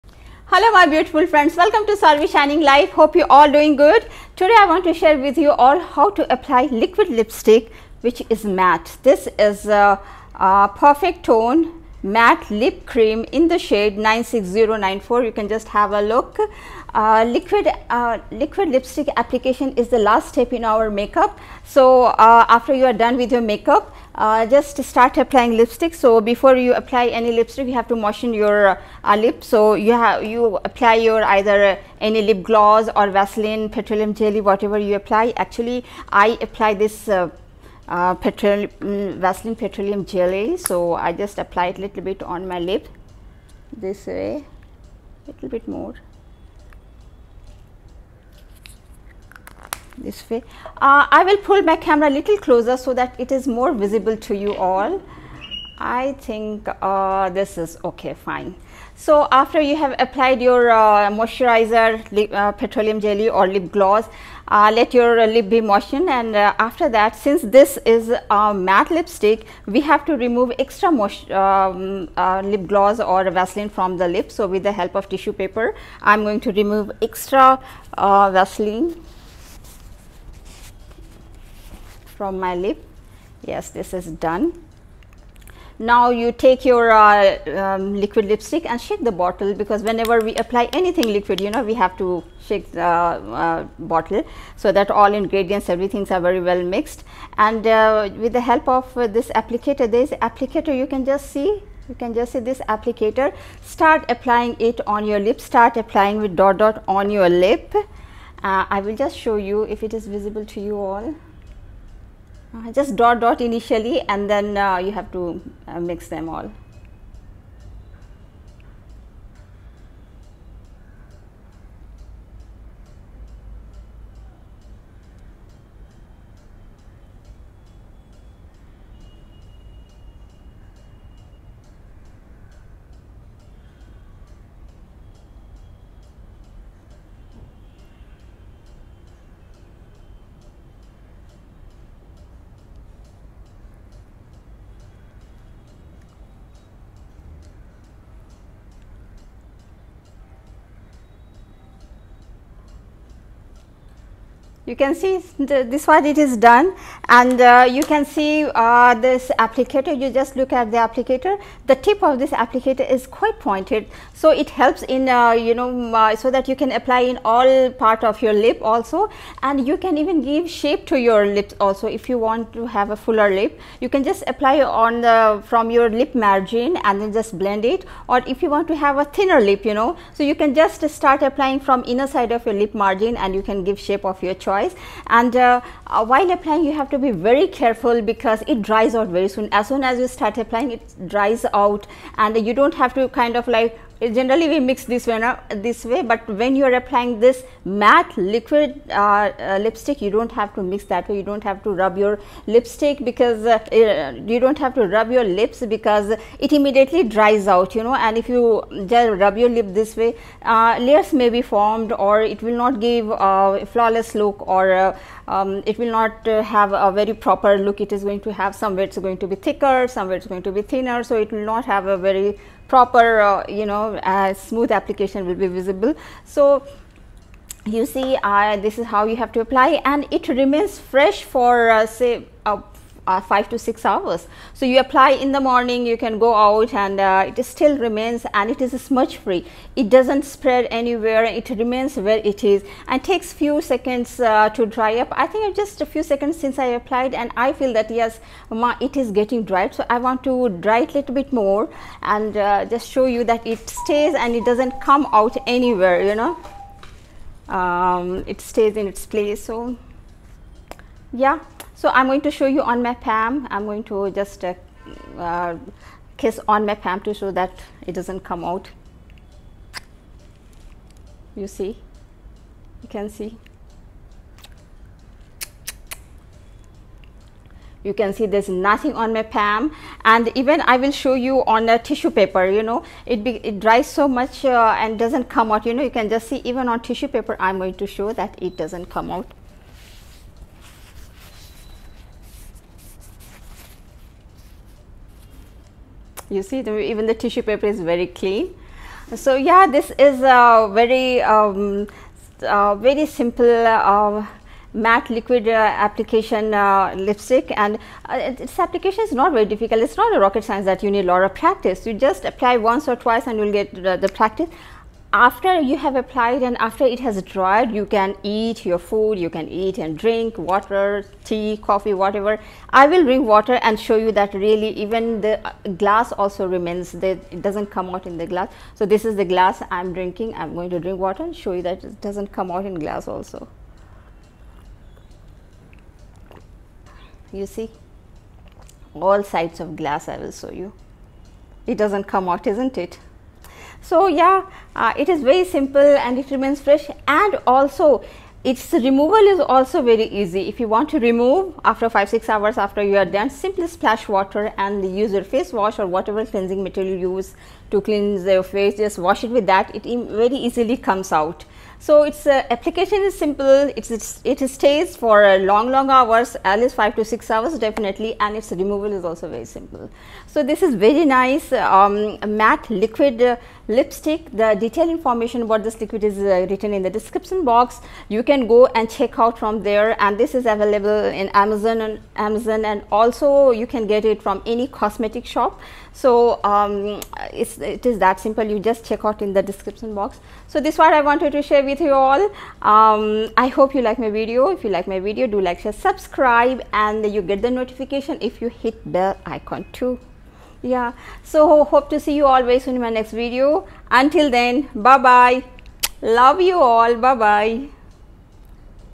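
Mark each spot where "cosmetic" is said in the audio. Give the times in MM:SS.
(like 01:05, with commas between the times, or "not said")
06:24.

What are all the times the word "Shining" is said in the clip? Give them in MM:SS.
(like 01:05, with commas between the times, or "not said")
00:02.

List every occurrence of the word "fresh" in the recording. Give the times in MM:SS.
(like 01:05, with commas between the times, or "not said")
03:50, 05:46.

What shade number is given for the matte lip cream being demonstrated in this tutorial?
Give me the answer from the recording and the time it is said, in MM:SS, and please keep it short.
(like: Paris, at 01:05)
96094, at 00:13.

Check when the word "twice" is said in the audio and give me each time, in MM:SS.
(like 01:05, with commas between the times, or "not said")
05:12.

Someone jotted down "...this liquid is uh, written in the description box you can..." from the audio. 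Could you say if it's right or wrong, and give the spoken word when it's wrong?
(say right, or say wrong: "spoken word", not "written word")
right.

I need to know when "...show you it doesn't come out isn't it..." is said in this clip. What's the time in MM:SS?
05:40.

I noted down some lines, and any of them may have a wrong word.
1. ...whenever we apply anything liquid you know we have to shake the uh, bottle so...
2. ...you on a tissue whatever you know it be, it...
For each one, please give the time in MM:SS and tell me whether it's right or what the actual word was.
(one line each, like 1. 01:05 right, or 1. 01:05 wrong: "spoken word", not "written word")
1. 01:29 right
2. 04:41 wrong: "paper", not "whatever".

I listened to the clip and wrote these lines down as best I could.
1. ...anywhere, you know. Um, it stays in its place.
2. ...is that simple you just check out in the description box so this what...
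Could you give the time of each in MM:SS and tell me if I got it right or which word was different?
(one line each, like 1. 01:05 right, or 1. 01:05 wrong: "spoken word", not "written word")
1. 04:15 right
2. 06:27 right.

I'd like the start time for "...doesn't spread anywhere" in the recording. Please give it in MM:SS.
03:59.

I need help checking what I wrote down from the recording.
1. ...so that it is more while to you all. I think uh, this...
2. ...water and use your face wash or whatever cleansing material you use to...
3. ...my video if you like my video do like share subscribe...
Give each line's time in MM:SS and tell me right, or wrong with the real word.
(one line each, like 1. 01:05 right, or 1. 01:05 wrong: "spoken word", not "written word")
1. 00:52 wrong: "visible", not "while"
2. 05:54 right
3. 06:34 right.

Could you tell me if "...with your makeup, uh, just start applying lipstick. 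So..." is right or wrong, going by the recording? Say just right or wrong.
right.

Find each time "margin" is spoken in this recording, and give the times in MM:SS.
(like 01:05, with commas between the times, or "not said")
02:56, 03:02.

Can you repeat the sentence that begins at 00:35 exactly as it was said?
Actually, I apply this uh, uh, petroleum, mm, Vaseline petroleum jelly.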